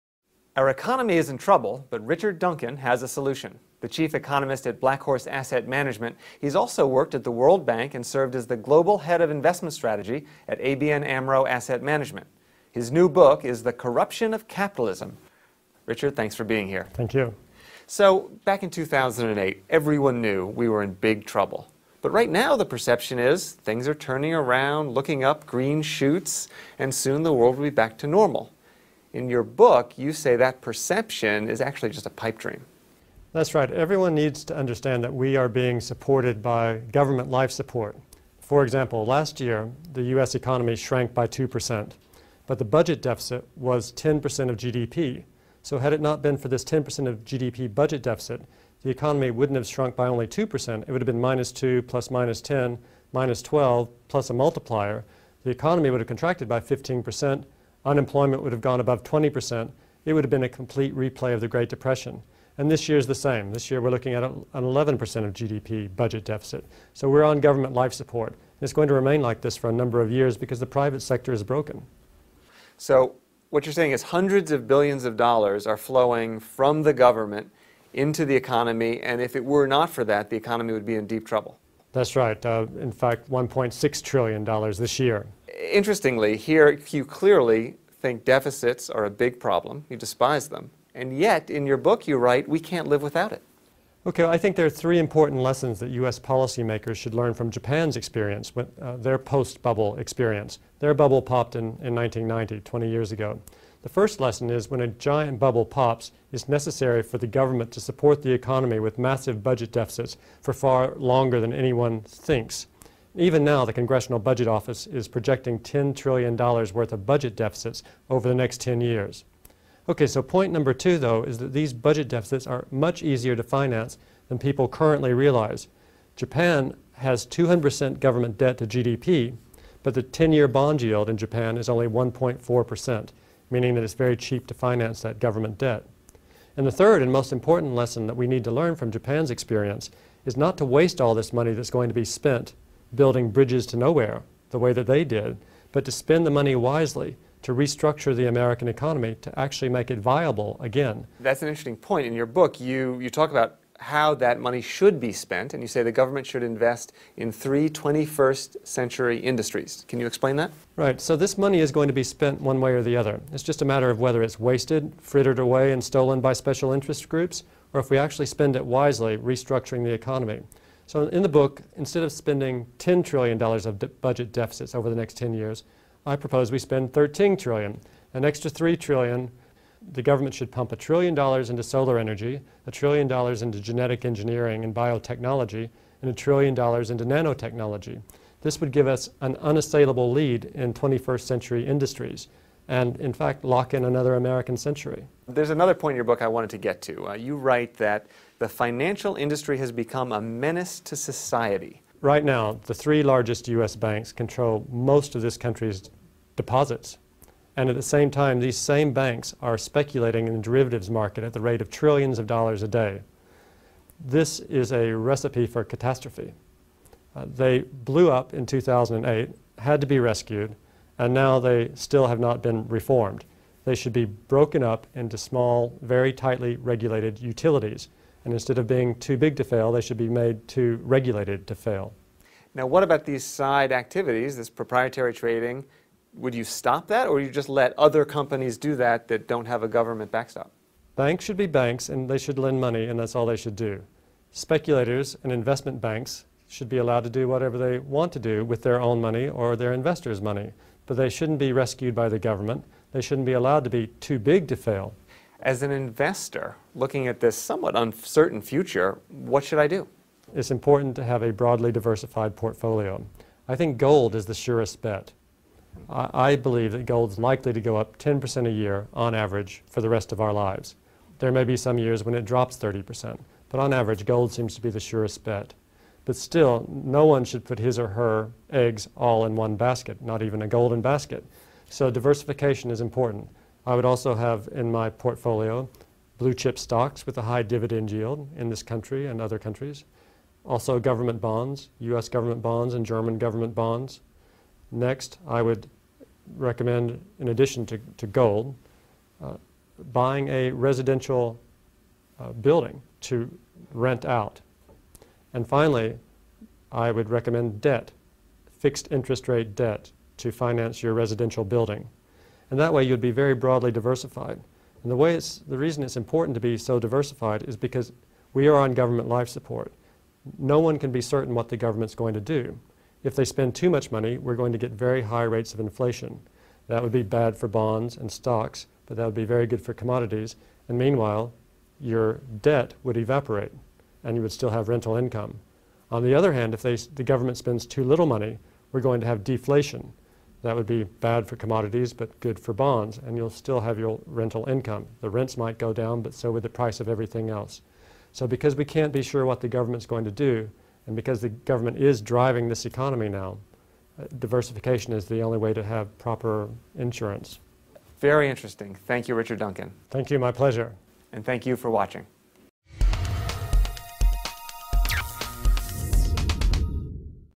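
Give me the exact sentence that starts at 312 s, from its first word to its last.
And that way you'd be very broadly diversified.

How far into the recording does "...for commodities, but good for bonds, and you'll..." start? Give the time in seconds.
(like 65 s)
341 s.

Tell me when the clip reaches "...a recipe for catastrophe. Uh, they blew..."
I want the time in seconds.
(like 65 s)
214 s.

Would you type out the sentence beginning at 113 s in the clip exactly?
Even now, the Congressional Budget Office is projecting $10 trillion worth of budget deficits over the next 10 years.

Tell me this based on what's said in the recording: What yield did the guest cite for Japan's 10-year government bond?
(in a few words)
1.4%.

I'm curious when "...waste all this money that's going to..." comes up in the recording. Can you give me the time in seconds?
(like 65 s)
140 s.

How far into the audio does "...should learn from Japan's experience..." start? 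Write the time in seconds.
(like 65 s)
96 s.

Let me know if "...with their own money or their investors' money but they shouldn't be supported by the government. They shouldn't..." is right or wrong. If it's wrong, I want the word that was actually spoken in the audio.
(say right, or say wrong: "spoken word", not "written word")
wrong: "rescued", not "supported".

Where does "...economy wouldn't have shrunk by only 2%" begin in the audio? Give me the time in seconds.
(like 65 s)
48 s.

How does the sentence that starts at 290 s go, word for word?
Also government bonds, US government bonds and German government bonds.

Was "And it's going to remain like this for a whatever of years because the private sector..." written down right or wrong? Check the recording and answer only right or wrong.
wrong.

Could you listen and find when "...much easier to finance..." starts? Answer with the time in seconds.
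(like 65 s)
122 s.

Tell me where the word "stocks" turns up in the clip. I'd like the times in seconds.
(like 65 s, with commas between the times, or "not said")
286 s, 328 s.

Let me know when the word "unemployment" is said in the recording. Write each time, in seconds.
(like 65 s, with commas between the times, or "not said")
57 s.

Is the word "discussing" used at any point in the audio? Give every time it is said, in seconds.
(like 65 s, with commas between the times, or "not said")
not said.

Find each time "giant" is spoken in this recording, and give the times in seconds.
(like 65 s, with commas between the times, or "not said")
104 s.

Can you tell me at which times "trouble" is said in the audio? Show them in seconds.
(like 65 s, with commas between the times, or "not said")
1 s, 21 s, 81 s.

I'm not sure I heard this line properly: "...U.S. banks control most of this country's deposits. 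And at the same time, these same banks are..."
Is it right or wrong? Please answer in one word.
right.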